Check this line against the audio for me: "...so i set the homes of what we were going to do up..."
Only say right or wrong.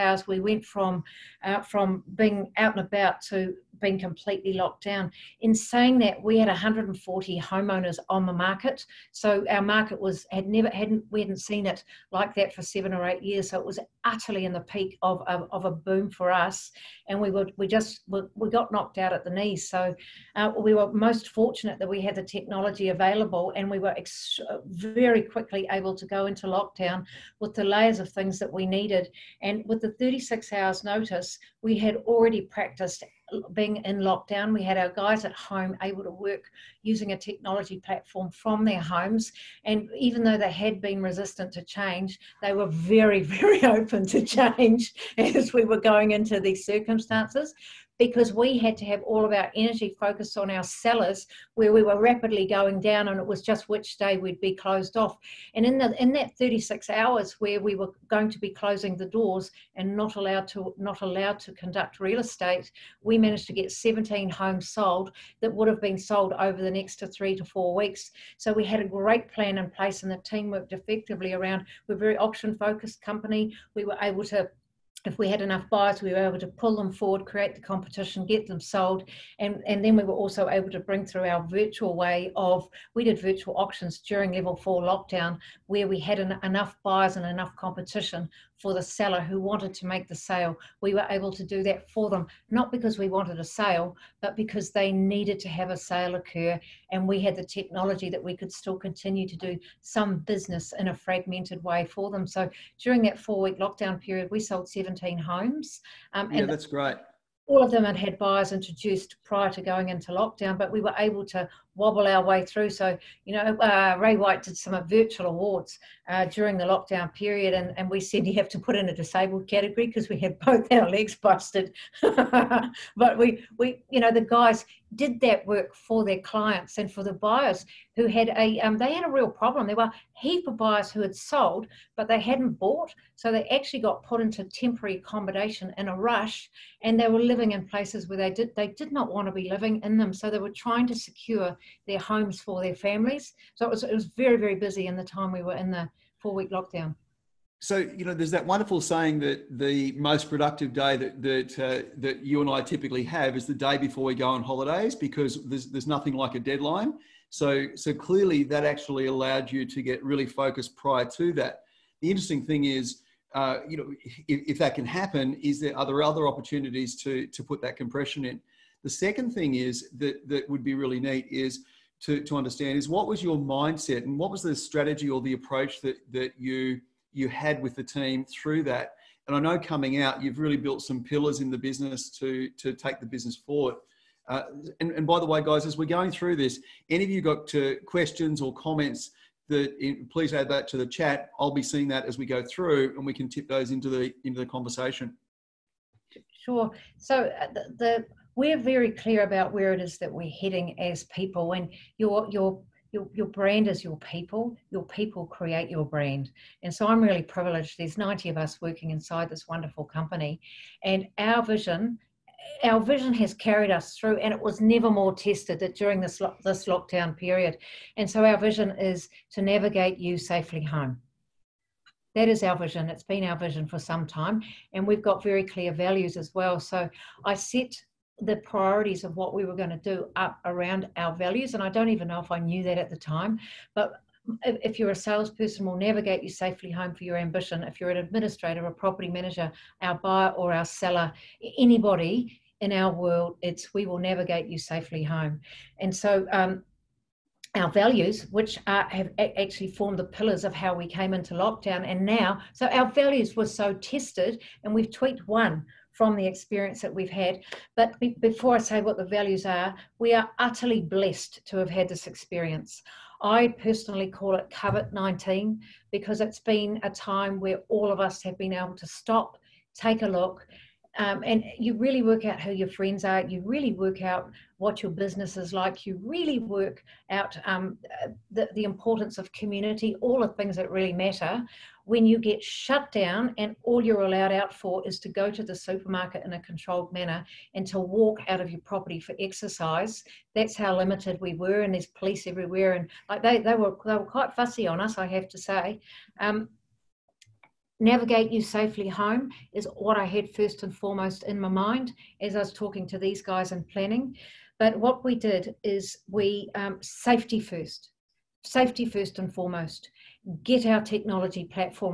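wrong.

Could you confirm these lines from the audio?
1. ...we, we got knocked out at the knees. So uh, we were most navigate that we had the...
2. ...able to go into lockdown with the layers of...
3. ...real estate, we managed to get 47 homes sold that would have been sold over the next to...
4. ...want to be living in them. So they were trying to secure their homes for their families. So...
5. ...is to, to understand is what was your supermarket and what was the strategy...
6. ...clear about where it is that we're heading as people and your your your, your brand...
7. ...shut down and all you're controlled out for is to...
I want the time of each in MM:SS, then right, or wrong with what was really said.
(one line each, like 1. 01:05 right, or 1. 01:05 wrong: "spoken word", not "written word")
1. 00:18 wrong: "fortunate", not "navigate"
2. 00:25 right
3. 01:01 wrong: "17", not "47"
4. 02:19 right
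5. 02:51 wrong: "mindset", not "supermarket"
6. 03:18 right
7. 04:42 wrong: "allowed", not "controlled".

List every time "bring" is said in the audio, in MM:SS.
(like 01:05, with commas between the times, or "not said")
01:20.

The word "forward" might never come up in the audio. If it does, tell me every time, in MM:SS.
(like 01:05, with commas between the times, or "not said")
01:16, 03:03.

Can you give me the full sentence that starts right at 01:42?
So during that four week lockdown period, we sold 17 homes.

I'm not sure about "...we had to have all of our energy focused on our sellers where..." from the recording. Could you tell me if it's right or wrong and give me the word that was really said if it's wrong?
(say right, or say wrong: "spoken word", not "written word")
right.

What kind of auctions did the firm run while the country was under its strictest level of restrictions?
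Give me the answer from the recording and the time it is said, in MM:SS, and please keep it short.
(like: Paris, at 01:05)
Virtual auctions, at 01:23.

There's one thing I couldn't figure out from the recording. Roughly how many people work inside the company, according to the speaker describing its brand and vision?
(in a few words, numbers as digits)
90.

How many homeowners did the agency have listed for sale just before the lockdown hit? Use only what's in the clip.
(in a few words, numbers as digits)
140.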